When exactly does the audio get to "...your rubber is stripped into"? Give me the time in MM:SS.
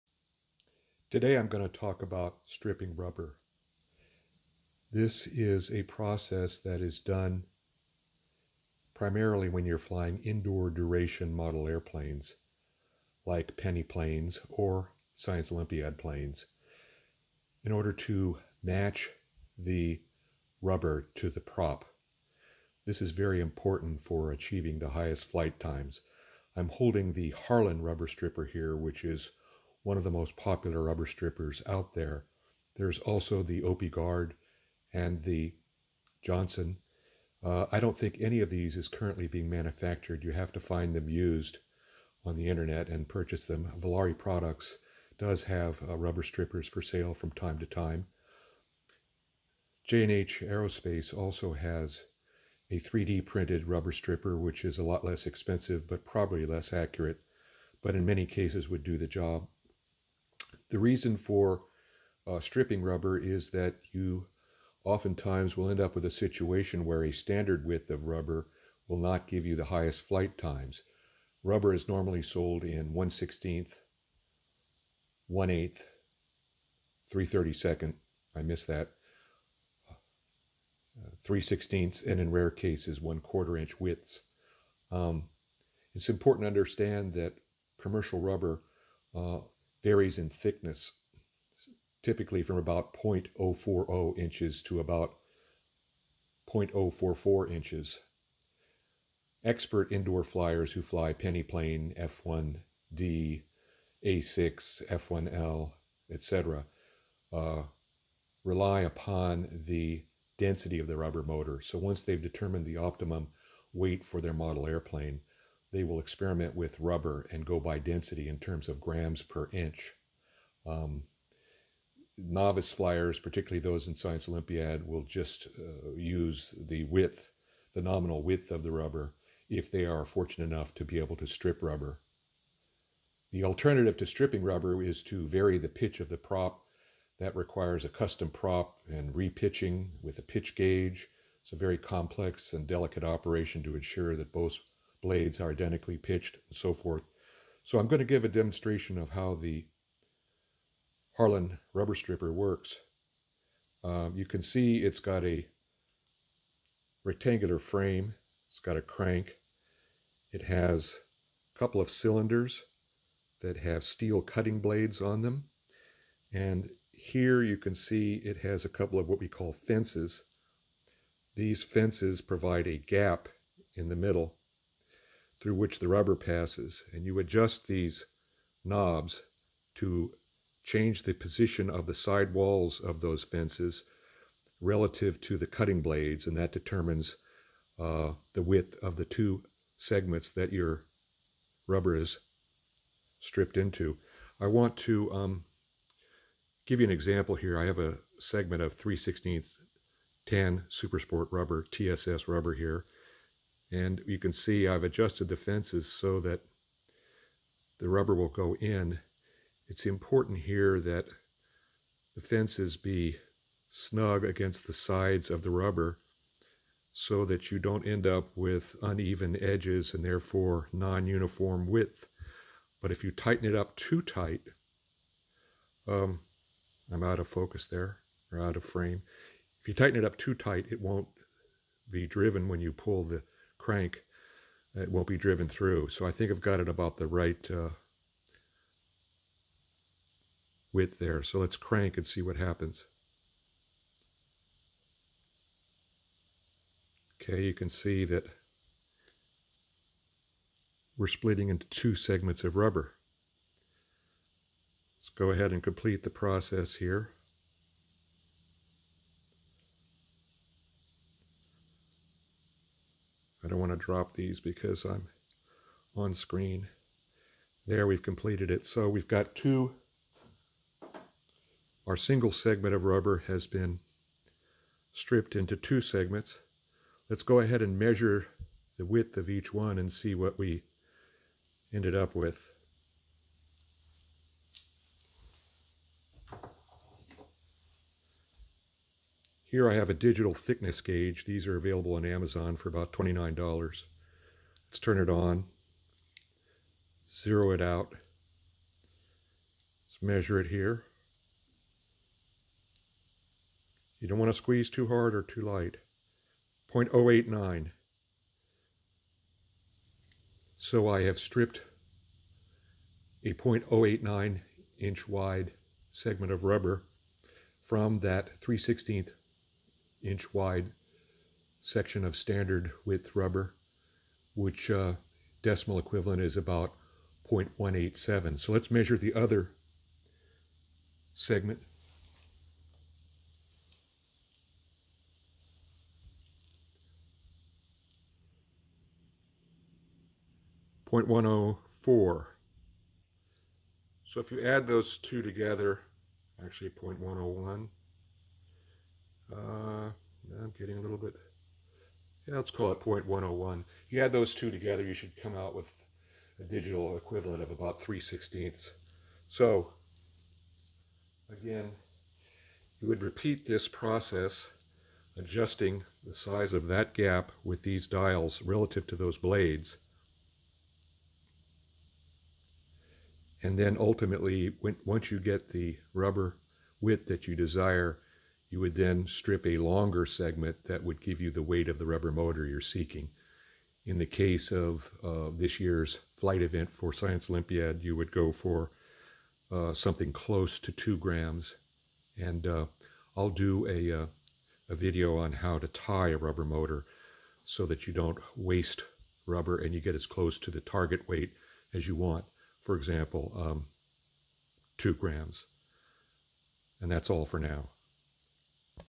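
03:10.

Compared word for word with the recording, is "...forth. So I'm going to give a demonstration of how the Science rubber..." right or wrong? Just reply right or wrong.
wrong.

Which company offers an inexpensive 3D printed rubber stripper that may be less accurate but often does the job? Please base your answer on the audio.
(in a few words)
J&H Aerospace.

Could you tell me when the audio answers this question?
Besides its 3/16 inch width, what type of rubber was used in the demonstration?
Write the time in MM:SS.
03:20.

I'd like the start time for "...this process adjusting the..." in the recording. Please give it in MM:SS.
06:03.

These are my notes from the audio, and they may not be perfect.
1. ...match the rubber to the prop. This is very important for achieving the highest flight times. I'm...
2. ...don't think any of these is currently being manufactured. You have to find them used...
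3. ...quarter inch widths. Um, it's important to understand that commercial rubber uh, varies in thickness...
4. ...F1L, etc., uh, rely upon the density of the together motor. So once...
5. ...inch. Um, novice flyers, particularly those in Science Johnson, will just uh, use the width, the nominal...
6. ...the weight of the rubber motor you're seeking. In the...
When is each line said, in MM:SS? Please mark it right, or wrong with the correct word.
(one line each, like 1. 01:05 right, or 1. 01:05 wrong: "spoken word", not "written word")
1. 00:18 right
2. 00:37 right
3. 01:23 right
4. 01:44 wrong: "rubber", not "together"
5. 01:59 wrong: "Olympiad", not "Johnson"
6. 06:21 right.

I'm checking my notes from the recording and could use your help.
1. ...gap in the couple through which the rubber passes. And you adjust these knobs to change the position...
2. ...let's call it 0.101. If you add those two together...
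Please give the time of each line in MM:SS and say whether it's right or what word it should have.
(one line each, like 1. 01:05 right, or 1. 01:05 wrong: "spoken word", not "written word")
1. 02:52 wrong: "middle", not "couple"
2. 05:52 right.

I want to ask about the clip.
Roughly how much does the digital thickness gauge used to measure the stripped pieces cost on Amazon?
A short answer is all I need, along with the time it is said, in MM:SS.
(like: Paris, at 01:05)
$29, at 04:52.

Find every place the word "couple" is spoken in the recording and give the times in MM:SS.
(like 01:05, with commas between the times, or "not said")
02:41, 02:48.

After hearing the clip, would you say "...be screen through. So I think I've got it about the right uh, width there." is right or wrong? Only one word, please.
wrong.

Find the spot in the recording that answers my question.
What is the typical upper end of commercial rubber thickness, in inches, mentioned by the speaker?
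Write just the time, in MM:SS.
01:36.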